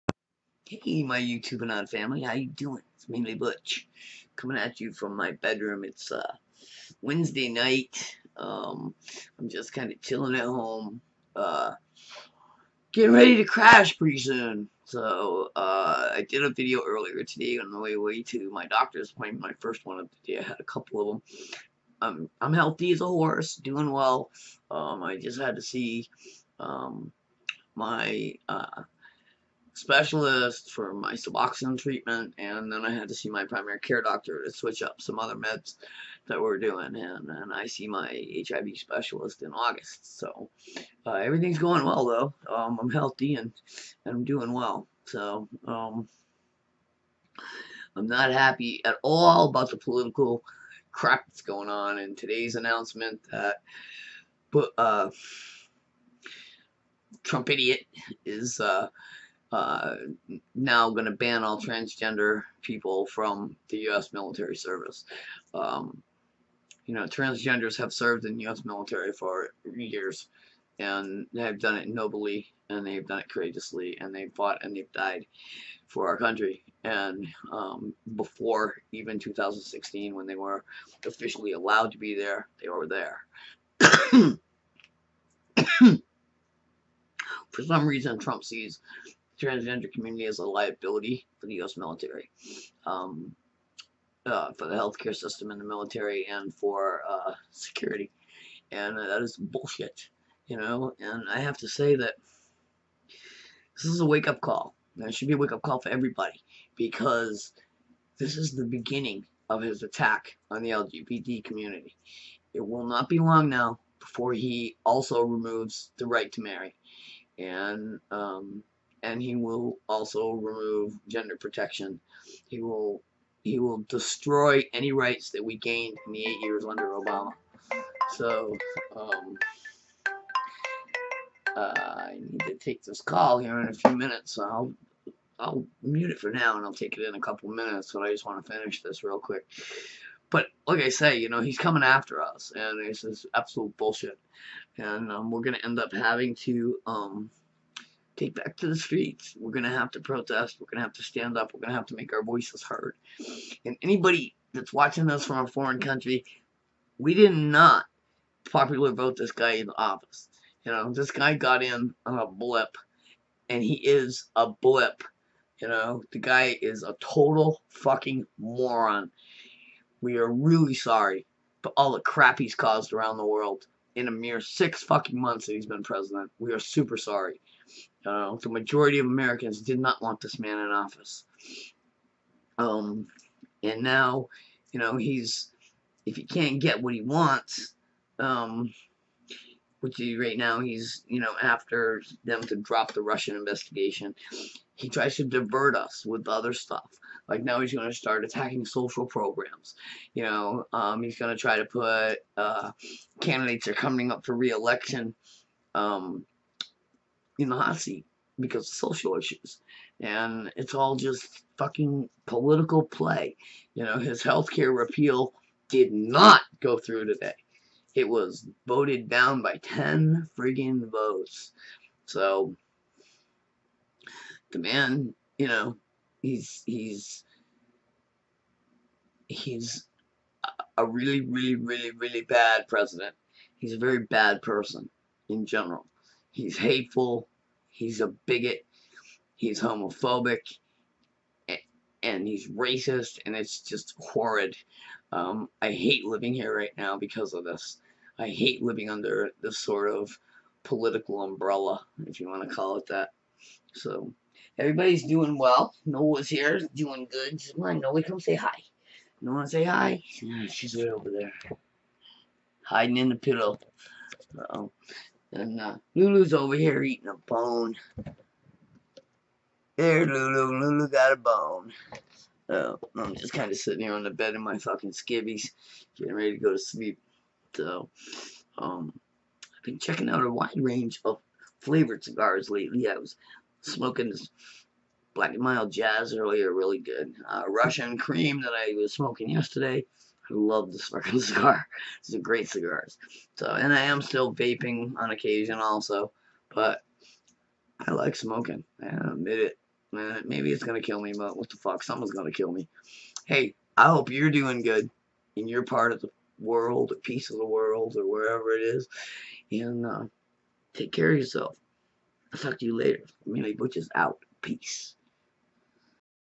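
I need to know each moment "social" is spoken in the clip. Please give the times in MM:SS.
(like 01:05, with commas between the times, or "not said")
03:18, 03:28.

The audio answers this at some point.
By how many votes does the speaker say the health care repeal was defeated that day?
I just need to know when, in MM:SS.
03:39.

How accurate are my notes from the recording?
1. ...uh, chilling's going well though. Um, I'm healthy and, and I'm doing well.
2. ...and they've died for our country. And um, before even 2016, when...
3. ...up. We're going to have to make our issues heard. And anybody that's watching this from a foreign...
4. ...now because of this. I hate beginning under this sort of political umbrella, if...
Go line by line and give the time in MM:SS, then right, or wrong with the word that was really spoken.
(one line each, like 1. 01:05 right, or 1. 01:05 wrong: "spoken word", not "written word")
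1. 00:41 wrong: "everything", not "chilling"
2. 01:14 right
3. 02:31 wrong: "voices", not "issues"
4. 04:06 wrong: "living", not "beginning".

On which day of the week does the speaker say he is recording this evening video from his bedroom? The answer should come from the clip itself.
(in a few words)
Wednesday.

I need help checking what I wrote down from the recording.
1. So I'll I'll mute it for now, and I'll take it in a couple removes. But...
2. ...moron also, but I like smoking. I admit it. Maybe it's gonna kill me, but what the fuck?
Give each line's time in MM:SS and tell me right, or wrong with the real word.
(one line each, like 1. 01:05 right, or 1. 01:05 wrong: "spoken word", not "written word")
1. 02:14 wrong: "minutes", not "removes"
2. 04:55 wrong: "occasion", not "moron".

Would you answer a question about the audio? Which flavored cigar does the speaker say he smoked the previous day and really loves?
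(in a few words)
Russian cream.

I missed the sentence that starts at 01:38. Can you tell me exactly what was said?
And that is bullshit, you know.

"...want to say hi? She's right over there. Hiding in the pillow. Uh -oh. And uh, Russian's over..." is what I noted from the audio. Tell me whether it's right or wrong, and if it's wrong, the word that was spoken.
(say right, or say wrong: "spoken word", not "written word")
wrong: "Lulu", not "Russian".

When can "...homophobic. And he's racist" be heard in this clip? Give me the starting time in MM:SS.
03:59.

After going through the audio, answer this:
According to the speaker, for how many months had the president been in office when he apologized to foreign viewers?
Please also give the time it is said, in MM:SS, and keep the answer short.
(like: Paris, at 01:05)
6, at 02:54.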